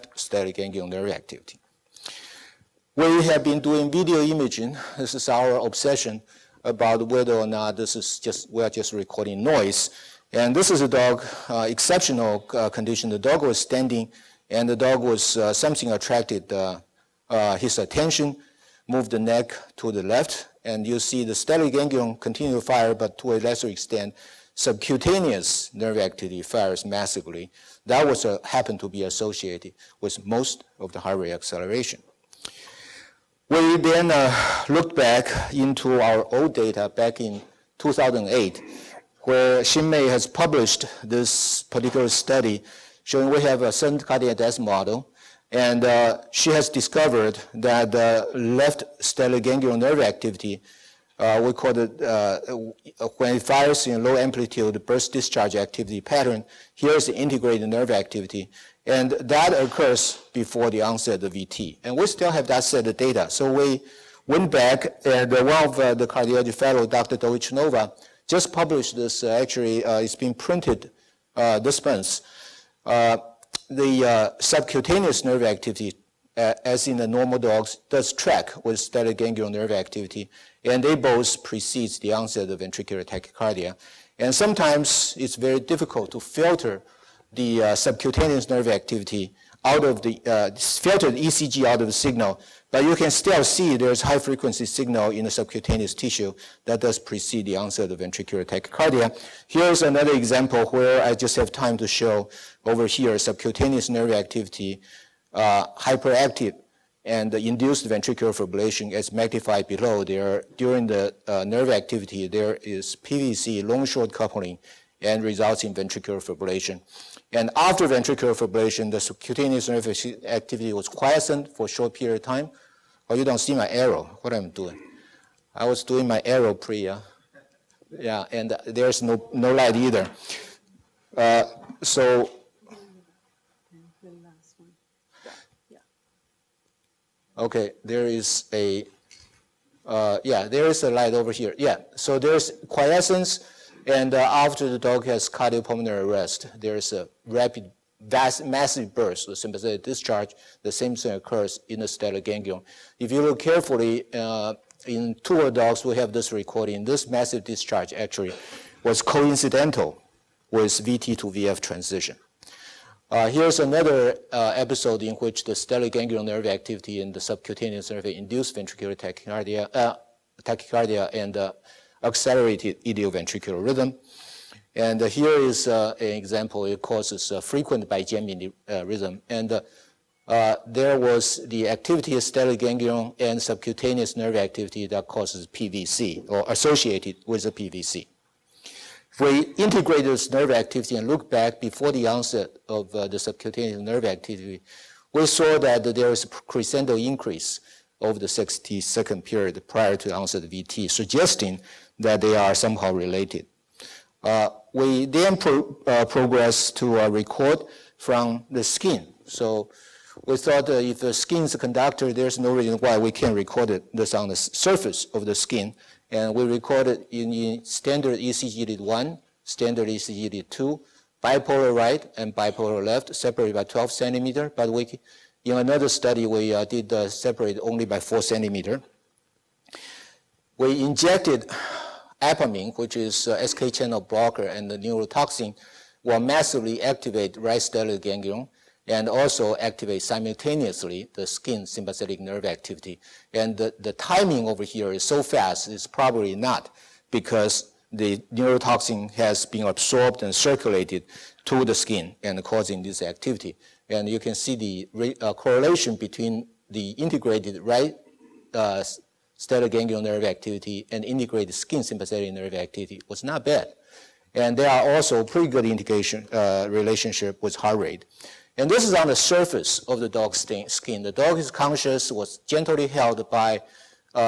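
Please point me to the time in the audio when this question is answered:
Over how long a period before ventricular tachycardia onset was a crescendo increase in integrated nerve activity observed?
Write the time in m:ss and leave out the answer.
3:18.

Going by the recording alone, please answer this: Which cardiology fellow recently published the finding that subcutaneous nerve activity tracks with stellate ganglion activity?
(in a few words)
Dr. Doytchinova.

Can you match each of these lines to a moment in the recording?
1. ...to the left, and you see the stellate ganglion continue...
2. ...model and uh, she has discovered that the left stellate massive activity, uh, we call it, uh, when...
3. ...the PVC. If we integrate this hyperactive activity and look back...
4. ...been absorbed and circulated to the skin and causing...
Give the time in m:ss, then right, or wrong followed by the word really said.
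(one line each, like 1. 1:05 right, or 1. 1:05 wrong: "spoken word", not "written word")
1. 0:19 right
2. 0:44 wrong: "nerve", not "massive"
3. 3:07 wrong: "nerve", not "hyperactive"
4. 4:09 right.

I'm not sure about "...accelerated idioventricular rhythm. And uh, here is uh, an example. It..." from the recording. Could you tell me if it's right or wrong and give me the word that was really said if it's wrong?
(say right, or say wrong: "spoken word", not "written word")
right.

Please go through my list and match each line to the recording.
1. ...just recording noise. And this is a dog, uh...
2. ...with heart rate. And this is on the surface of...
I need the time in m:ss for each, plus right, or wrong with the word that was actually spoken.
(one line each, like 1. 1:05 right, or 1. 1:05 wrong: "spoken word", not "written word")
1. 0:08 right
2. 4:27 right.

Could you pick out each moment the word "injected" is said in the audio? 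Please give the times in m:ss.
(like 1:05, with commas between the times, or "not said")
3:50.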